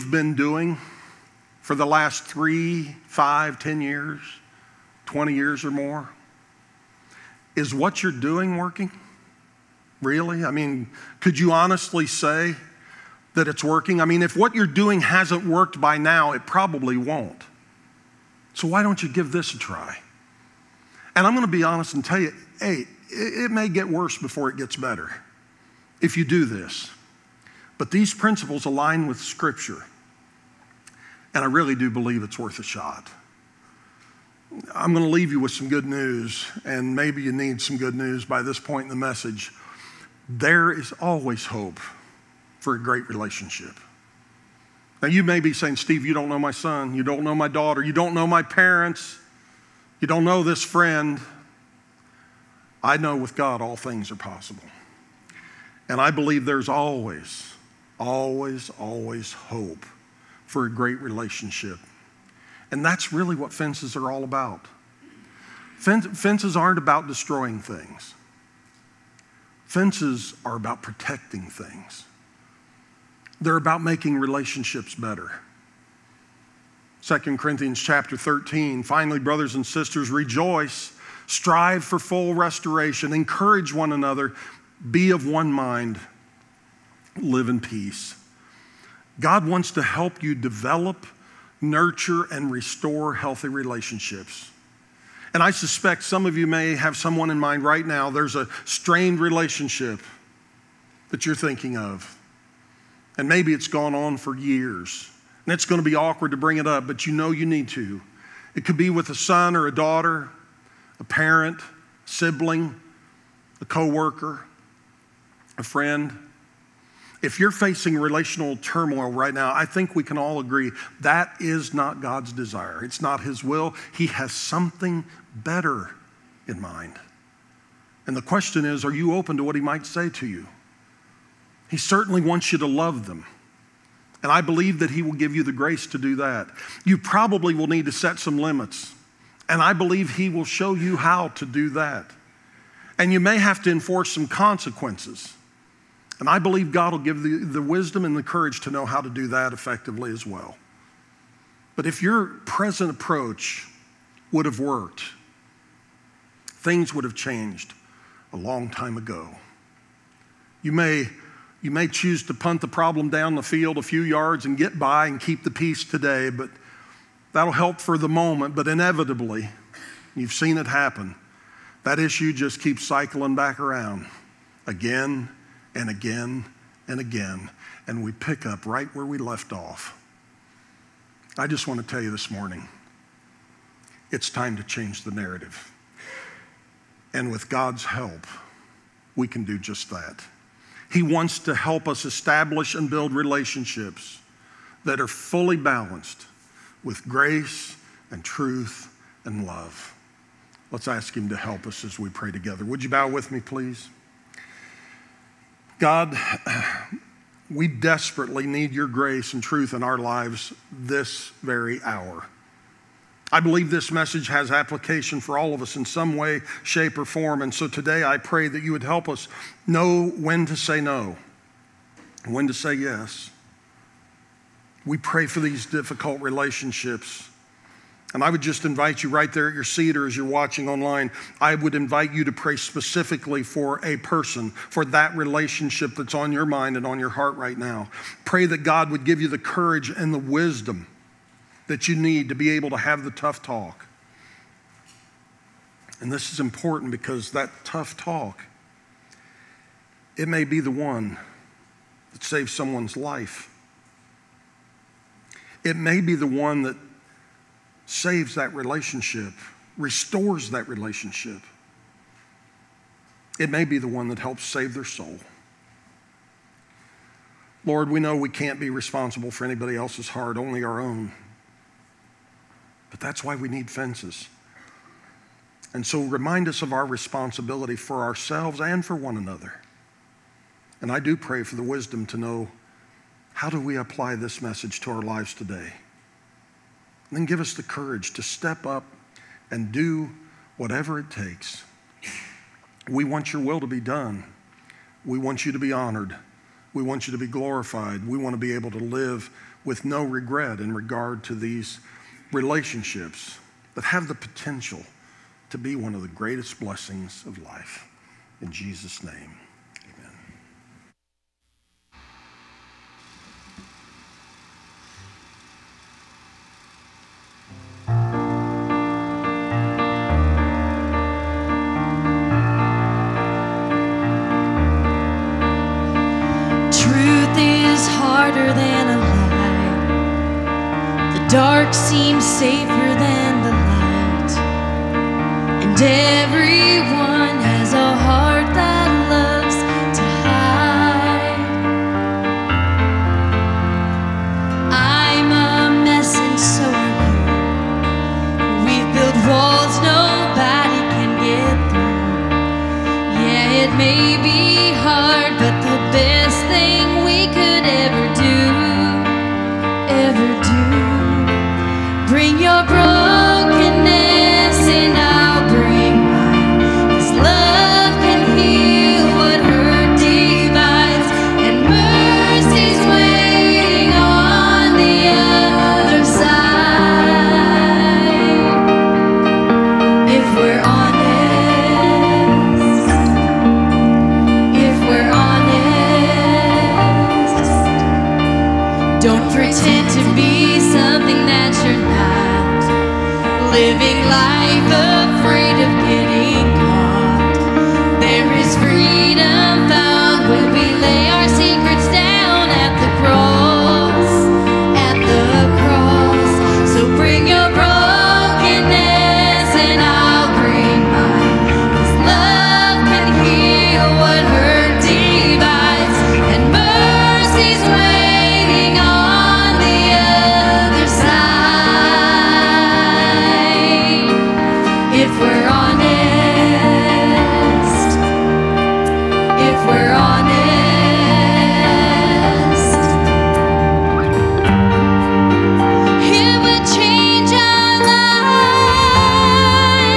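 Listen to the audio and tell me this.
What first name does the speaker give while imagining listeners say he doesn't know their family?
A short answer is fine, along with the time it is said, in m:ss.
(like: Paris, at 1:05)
Steve, at 0:45.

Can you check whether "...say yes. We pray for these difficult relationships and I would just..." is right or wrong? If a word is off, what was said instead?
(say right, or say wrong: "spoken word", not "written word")
right.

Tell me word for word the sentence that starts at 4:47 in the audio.
And then give us the courage to step up and do whatever it takes.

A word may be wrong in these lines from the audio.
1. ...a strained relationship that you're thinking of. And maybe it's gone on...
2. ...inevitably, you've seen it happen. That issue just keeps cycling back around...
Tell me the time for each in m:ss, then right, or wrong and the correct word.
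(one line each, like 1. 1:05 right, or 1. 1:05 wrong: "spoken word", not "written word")
1. 1:38 right
2. 2:48 right.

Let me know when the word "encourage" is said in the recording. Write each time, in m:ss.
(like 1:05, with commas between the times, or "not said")
1:23.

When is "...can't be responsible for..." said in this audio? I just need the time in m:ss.
4:28.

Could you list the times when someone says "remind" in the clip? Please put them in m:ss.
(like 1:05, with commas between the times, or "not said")
4:36.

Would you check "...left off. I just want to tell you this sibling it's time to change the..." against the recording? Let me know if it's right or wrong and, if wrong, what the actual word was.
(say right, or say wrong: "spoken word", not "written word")
wrong: "morning", not "sibling".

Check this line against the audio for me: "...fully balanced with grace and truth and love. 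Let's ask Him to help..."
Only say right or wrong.
right.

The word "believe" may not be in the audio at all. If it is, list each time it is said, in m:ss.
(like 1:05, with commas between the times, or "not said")
0:31, 0:56, 2:14, 2:19, 2:26, 3:33.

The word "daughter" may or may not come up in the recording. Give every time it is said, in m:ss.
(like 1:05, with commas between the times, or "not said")
0:47, 1:49.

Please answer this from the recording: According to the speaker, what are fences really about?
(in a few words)
Protecting things.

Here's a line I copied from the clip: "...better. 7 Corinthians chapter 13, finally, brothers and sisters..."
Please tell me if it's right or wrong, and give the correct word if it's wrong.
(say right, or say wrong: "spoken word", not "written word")
wrong: "2", not "7".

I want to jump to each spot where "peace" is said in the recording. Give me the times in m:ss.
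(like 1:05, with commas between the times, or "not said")
1:27, 2:45.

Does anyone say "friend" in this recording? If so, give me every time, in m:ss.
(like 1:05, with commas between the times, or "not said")
0:50, 1:55.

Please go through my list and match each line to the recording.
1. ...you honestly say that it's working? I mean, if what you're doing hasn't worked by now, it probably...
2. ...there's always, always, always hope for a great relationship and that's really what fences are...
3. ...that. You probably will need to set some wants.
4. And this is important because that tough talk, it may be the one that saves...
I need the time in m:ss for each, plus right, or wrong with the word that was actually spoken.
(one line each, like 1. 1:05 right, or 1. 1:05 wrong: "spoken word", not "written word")
1. 0:11 right
2. 0:56 right
3. 2:16 wrong: "limits", not "wants"
4. 4:06 right.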